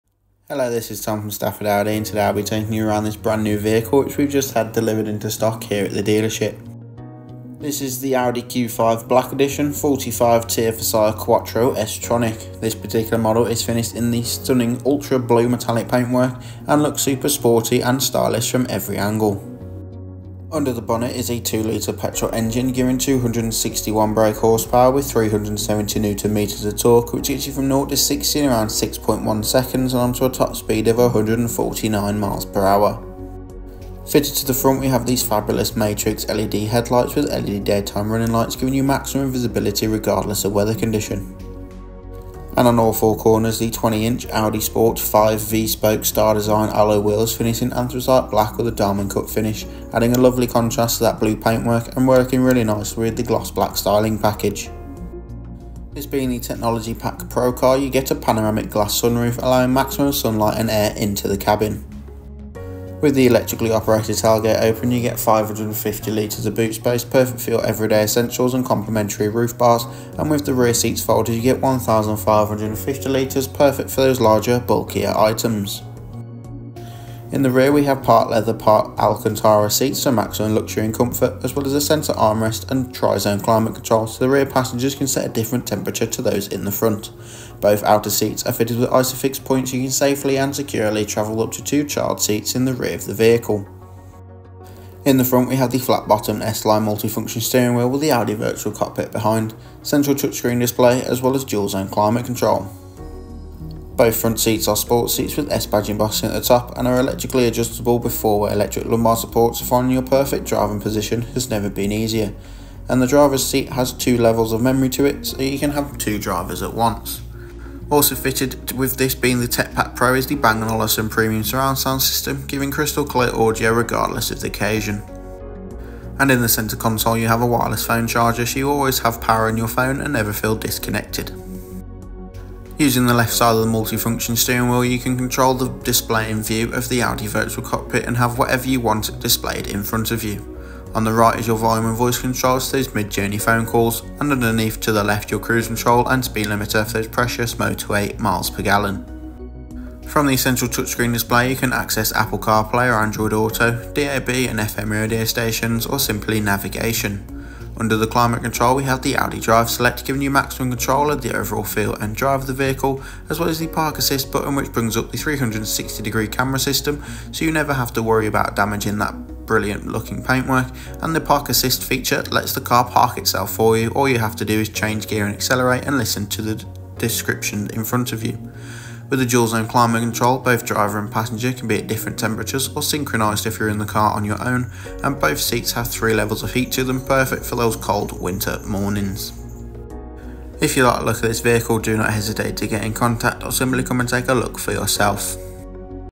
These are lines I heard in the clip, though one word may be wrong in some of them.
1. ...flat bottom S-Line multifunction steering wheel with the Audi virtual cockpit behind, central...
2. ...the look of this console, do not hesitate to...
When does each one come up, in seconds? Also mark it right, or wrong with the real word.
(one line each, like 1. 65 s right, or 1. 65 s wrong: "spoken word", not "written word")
1. 95 s right
2. 190 s wrong: "vehicle", not "console".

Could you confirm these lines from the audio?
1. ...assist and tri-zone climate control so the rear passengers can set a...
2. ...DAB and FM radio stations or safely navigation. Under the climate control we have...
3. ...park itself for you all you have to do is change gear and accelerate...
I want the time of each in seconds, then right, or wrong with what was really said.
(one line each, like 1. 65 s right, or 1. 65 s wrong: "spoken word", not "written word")
1. 82 s wrong: "armrest", not "assist"
2. 153 s wrong: "simply", not "safely"
3. 172 s right.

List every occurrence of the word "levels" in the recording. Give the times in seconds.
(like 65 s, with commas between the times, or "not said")
114 s, 186 s.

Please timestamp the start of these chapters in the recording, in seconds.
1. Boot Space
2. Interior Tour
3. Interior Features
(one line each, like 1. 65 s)
1. 88 s
2. 108 s
3. 156 s.